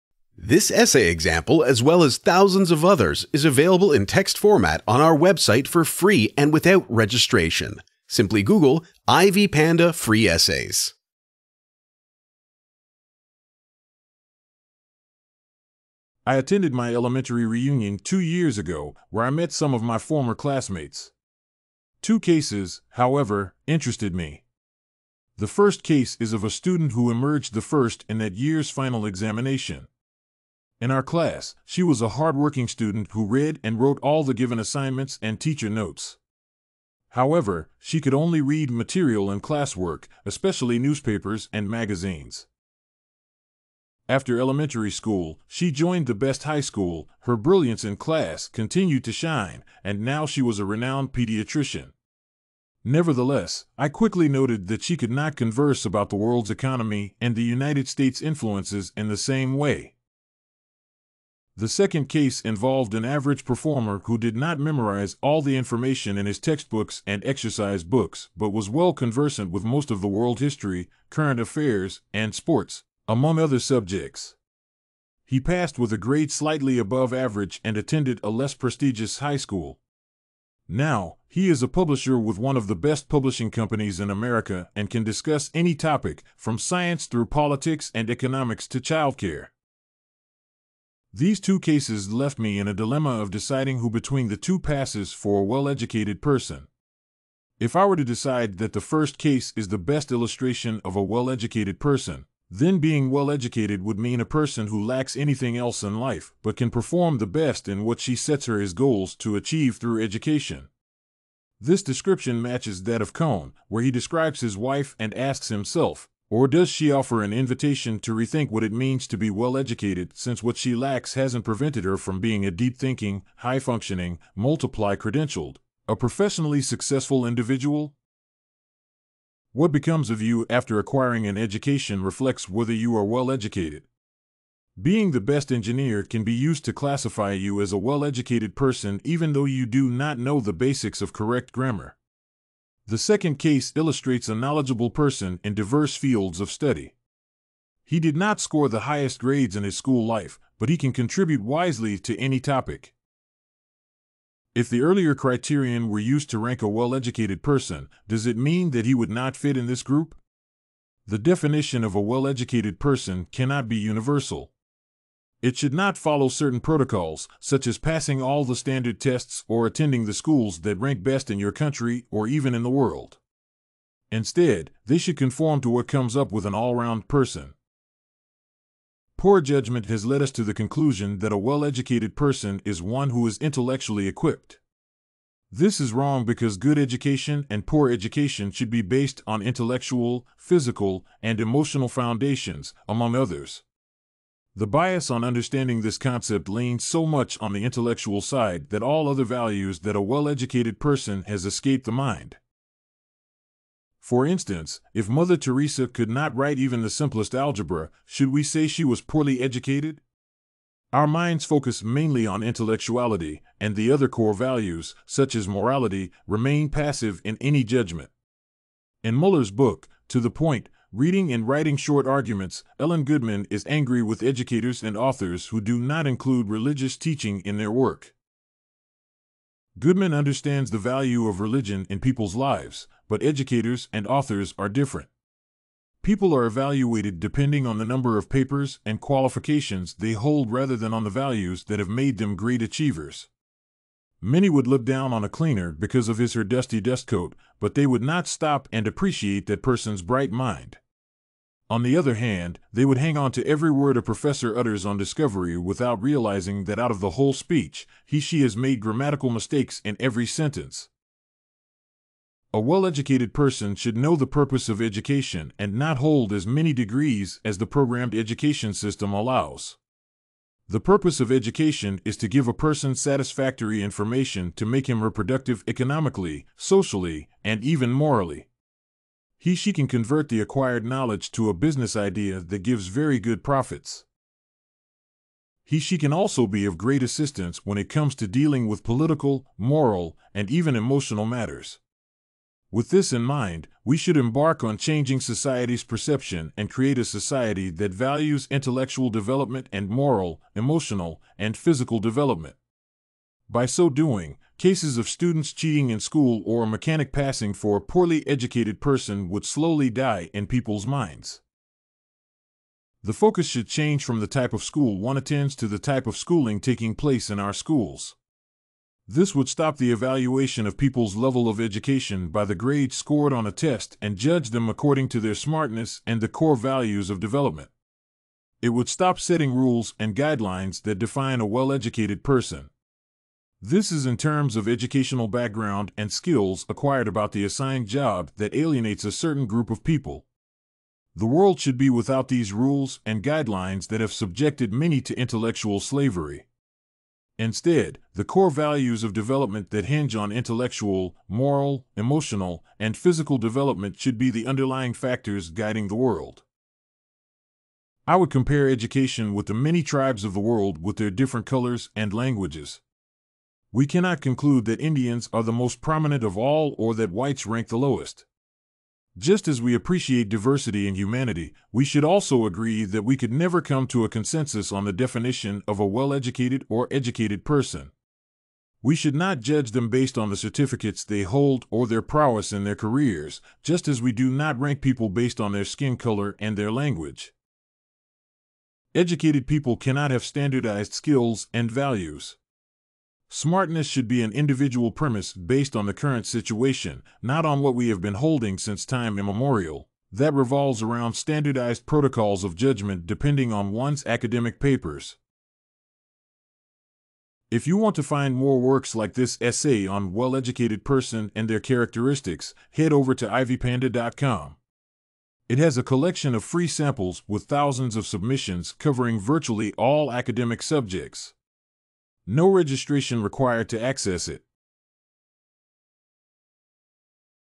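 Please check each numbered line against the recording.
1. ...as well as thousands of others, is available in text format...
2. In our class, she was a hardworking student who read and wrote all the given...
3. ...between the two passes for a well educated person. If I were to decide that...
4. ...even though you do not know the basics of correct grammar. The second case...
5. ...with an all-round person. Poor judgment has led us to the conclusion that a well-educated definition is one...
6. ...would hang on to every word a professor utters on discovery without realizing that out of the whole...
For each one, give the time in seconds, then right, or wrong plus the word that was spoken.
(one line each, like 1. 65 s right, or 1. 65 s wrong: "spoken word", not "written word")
1. 1 s right
2. 30 s right
3. 93 s right
4. 139 s right
5. 176 s wrong: "person", not "definition"
6. 252 s right.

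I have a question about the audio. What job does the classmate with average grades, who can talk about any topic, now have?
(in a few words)
publisher.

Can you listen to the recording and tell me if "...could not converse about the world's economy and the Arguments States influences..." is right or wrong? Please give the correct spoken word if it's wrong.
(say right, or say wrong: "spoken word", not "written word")
wrong: "United", not "Arguments".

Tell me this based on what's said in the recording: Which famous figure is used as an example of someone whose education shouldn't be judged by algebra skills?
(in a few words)
Mother Teresa.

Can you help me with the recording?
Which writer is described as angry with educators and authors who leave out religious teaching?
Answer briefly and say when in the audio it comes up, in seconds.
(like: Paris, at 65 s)
Ellen Goodman, at 222 s.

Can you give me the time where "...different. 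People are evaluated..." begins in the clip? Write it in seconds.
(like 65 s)
234 s.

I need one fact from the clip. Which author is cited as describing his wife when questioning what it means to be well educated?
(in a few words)
Kohn.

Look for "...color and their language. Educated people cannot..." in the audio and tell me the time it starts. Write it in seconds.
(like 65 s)
385 s.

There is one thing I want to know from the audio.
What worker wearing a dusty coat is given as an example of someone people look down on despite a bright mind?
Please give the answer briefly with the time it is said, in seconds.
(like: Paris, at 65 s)
cleaner, at 245 s.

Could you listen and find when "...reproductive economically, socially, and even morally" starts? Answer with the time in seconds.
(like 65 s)
275 s.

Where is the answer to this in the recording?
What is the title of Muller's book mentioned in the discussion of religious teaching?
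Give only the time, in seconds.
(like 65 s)
220 s.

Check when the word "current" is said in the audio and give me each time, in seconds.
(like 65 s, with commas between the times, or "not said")
71 s, 395 s.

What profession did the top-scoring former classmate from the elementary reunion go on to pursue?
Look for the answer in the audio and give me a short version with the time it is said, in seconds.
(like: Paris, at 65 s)
pediatrician, at 51 s.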